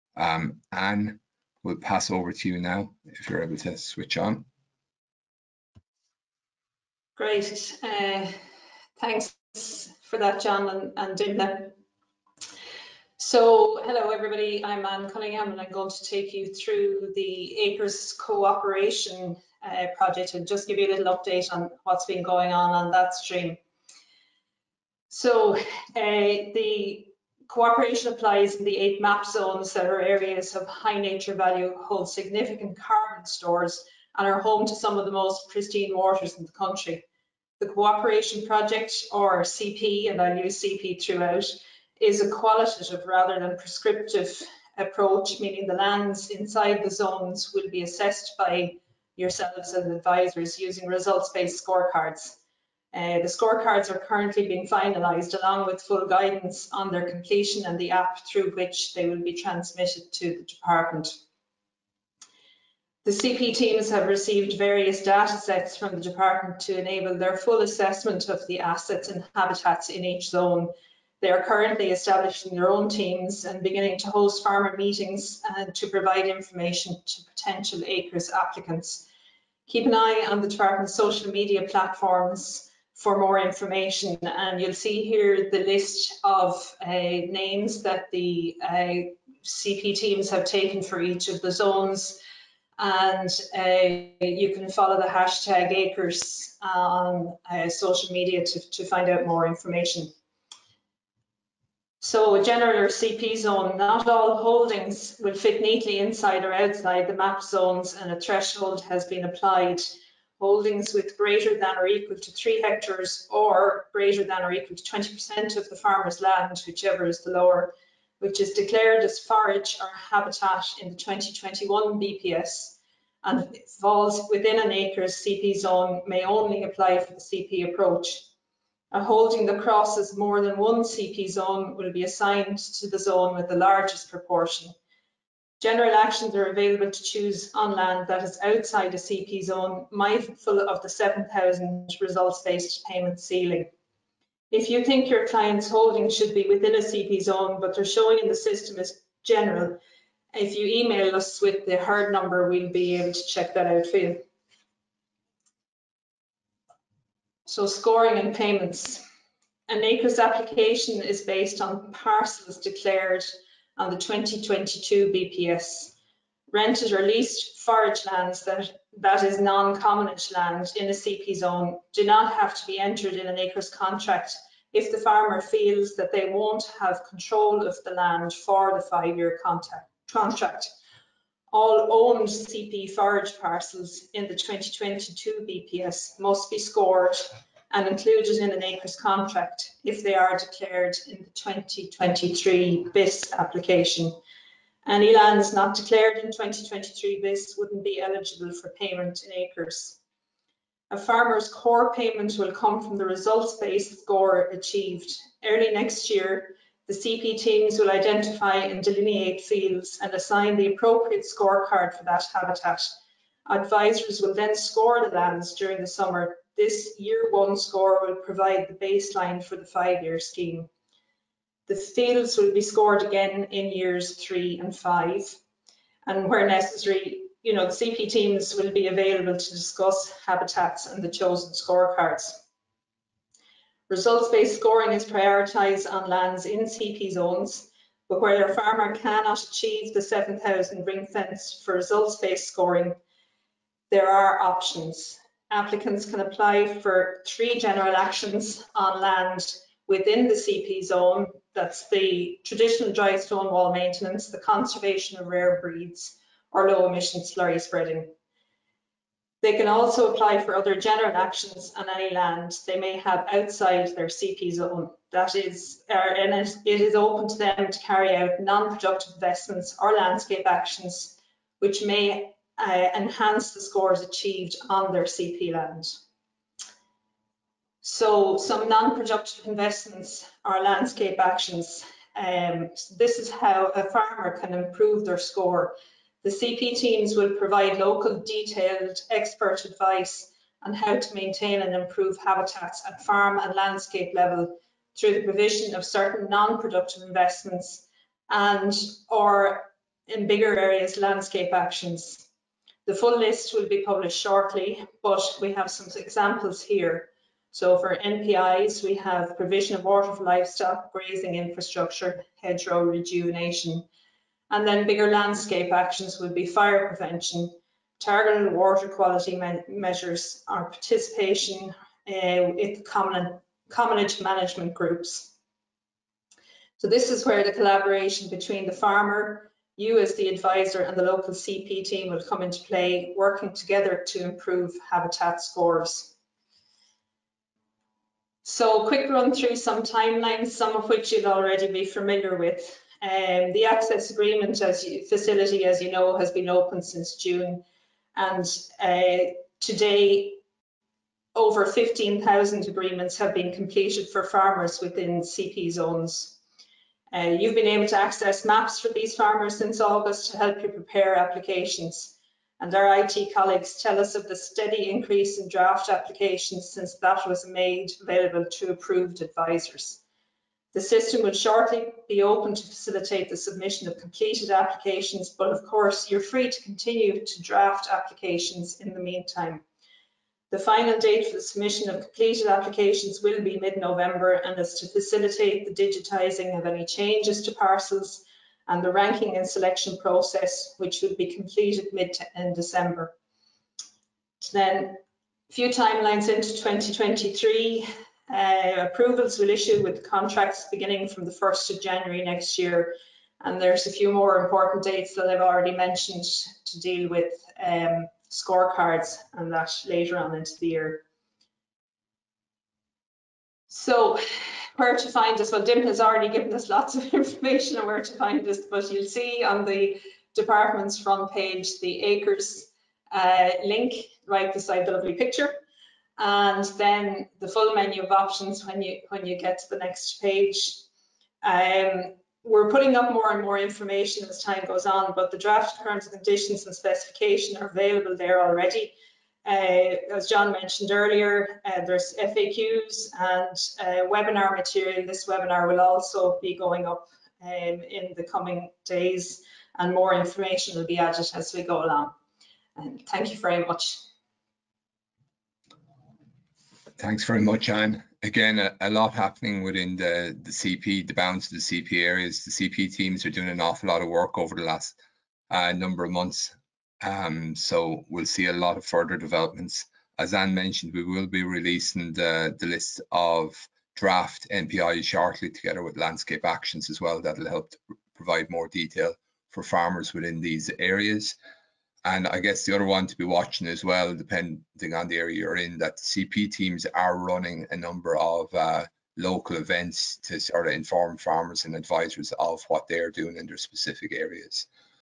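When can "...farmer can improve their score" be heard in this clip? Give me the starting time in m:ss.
4:43.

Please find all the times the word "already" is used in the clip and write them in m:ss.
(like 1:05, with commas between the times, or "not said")
5:41, 6:45, 6:55, 7:18.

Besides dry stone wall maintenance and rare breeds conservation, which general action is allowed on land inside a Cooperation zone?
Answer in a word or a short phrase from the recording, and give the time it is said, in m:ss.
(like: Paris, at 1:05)
Low emission slurry spreading, at 4:16.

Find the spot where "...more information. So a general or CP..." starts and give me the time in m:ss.
1:39.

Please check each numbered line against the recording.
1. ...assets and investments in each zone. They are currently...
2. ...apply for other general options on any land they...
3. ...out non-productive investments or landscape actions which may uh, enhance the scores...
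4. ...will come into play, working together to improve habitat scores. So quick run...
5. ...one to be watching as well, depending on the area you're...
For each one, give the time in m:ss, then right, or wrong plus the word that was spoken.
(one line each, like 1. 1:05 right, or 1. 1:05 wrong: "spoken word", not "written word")
1. 1:08 wrong: "habitats", not "investments"
2. 4:20 wrong: "actions", not "options"
3. 4:28 right
4. 5:32 right
5. 8:02 right.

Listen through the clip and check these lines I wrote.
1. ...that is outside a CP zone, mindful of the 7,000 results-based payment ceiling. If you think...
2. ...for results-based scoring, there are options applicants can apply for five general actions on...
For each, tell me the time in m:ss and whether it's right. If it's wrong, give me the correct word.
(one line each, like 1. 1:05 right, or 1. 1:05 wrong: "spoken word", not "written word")
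1. 2:18 right
2. 4:01 wrong: "three", not "five".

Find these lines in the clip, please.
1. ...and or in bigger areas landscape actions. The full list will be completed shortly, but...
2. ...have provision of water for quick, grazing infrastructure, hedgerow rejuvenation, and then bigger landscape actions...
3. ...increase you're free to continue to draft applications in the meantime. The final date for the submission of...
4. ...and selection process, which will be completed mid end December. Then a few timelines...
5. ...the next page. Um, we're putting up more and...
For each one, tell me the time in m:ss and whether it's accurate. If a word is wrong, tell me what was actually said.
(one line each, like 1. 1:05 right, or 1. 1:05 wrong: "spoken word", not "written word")
1. 4:58 wrong: "published", not "completed"
2. 5:08 wrong: "livestock", not "quick"
3. 6:15 wrong: "course", not "increase"
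4. 6:29 right
5. 7:09 right.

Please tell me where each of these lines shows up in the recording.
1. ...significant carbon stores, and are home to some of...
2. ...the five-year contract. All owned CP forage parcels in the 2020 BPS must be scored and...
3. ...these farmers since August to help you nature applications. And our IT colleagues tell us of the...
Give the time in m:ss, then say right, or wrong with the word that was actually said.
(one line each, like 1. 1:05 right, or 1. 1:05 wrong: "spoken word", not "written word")
1. 0:32 right
2. 2:58 wrong: "2022", not "2020"
3. 5:58 wrong: "prepare", not "nature".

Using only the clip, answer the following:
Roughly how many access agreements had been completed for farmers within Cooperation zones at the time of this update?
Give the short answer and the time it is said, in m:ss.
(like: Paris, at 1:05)
Over 15,000, at 5:51.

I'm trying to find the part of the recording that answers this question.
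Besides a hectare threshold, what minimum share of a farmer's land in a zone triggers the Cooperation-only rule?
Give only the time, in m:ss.
1:54.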